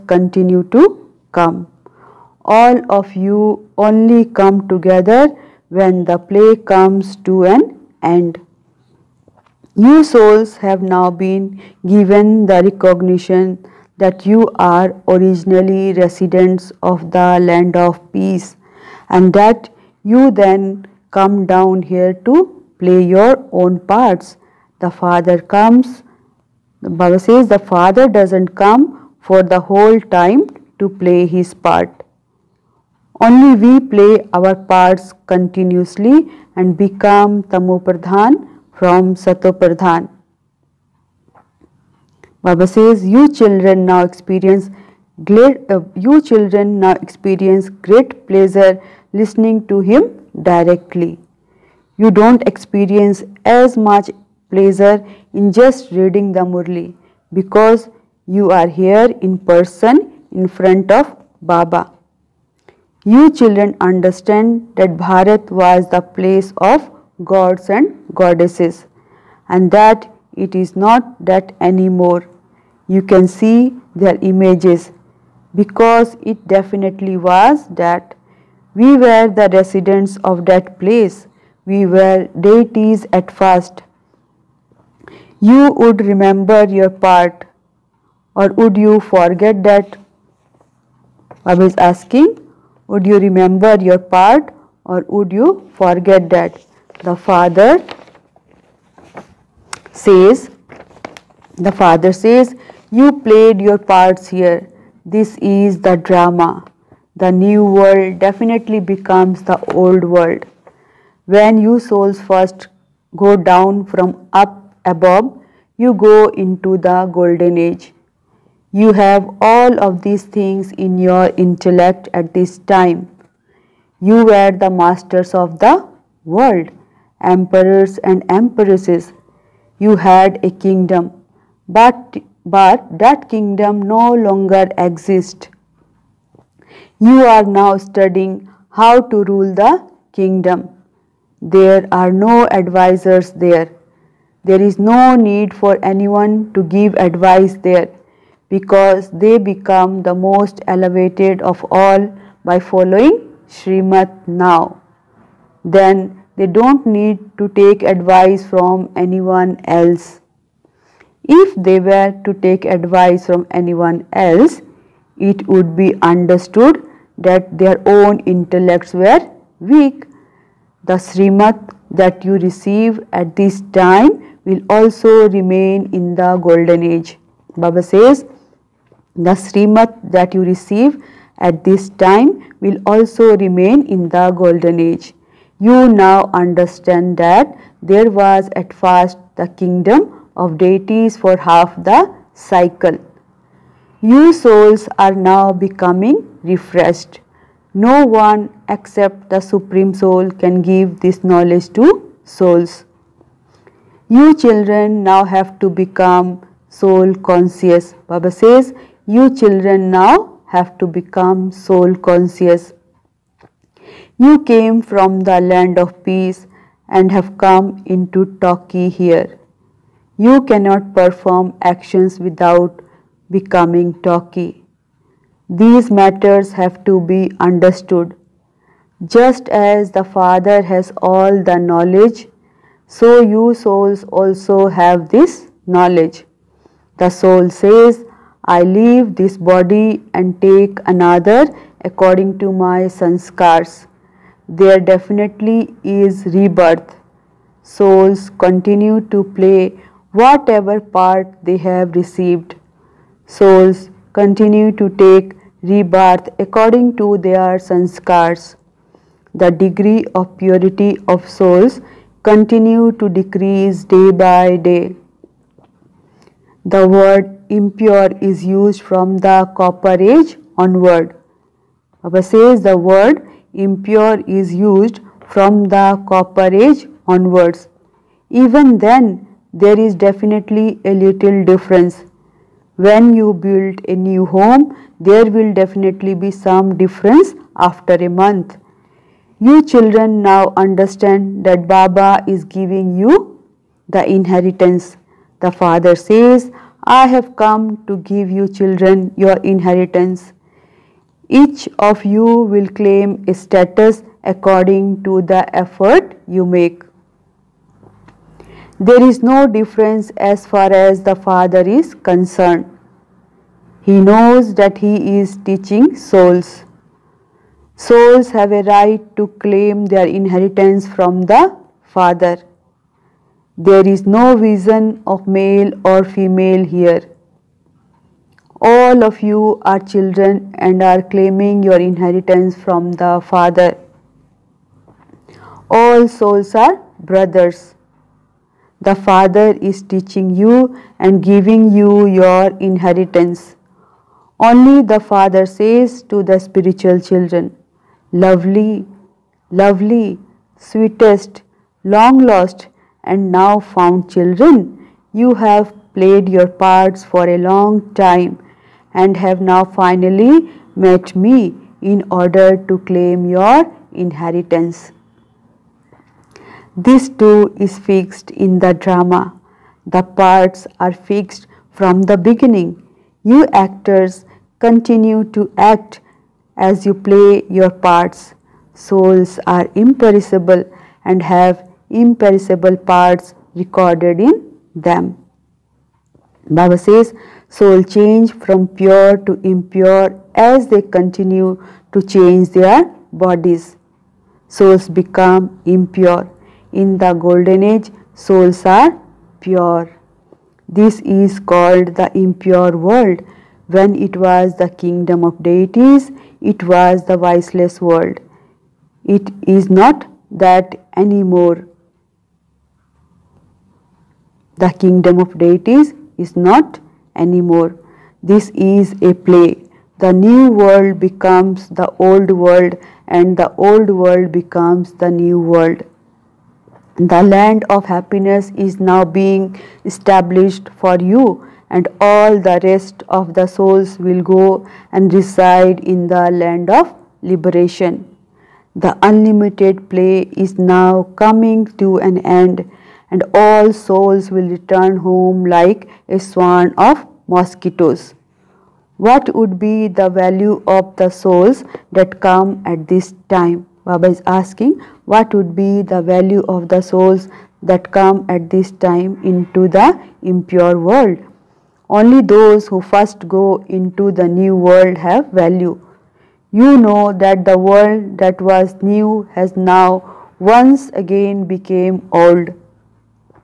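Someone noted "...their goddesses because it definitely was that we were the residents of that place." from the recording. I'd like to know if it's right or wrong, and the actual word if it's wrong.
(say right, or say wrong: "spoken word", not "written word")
wrong: "images", not "goddesses".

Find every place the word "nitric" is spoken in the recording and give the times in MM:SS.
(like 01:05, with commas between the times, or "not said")
not said.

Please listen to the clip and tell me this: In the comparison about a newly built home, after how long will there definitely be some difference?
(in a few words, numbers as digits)
A month.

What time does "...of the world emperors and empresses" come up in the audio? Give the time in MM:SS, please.
02:05.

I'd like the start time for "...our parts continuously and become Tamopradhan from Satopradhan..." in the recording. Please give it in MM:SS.
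00:34.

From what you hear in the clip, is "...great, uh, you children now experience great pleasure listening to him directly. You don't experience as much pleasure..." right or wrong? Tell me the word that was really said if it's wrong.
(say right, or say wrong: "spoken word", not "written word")
right.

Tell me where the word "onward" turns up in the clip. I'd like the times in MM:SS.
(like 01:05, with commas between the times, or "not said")
04:30, 04:37.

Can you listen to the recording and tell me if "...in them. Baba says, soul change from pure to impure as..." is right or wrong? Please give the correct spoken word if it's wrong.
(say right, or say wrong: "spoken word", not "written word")
right.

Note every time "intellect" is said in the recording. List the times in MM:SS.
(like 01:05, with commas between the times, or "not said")
02:01, 02:48.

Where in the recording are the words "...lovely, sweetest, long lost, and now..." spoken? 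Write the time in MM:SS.
05:49.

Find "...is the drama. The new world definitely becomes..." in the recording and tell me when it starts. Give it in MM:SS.
01:45.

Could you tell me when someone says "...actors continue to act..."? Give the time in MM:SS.
06:13.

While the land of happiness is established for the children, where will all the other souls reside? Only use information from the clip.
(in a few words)
Land of liberation.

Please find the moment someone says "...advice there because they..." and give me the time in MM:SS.
02:26.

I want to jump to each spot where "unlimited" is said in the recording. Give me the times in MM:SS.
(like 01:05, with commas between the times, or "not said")
07:19.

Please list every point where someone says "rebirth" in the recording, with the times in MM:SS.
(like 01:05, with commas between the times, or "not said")
04:06, 04:15.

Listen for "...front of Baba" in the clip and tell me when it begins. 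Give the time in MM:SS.
01:00.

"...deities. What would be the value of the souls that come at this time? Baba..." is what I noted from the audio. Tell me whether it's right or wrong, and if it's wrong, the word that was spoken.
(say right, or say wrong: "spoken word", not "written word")
wrong: "mosquitoes", not "deities".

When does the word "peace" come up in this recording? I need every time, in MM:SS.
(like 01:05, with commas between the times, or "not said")
00:18, 03:36.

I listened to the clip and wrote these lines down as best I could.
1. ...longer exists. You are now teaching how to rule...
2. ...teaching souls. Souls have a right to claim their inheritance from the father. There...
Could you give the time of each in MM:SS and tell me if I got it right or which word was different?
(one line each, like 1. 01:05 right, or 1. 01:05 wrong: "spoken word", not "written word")
1. 02:14 wrong: "studying", not "teaching"
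2. 05:15 right.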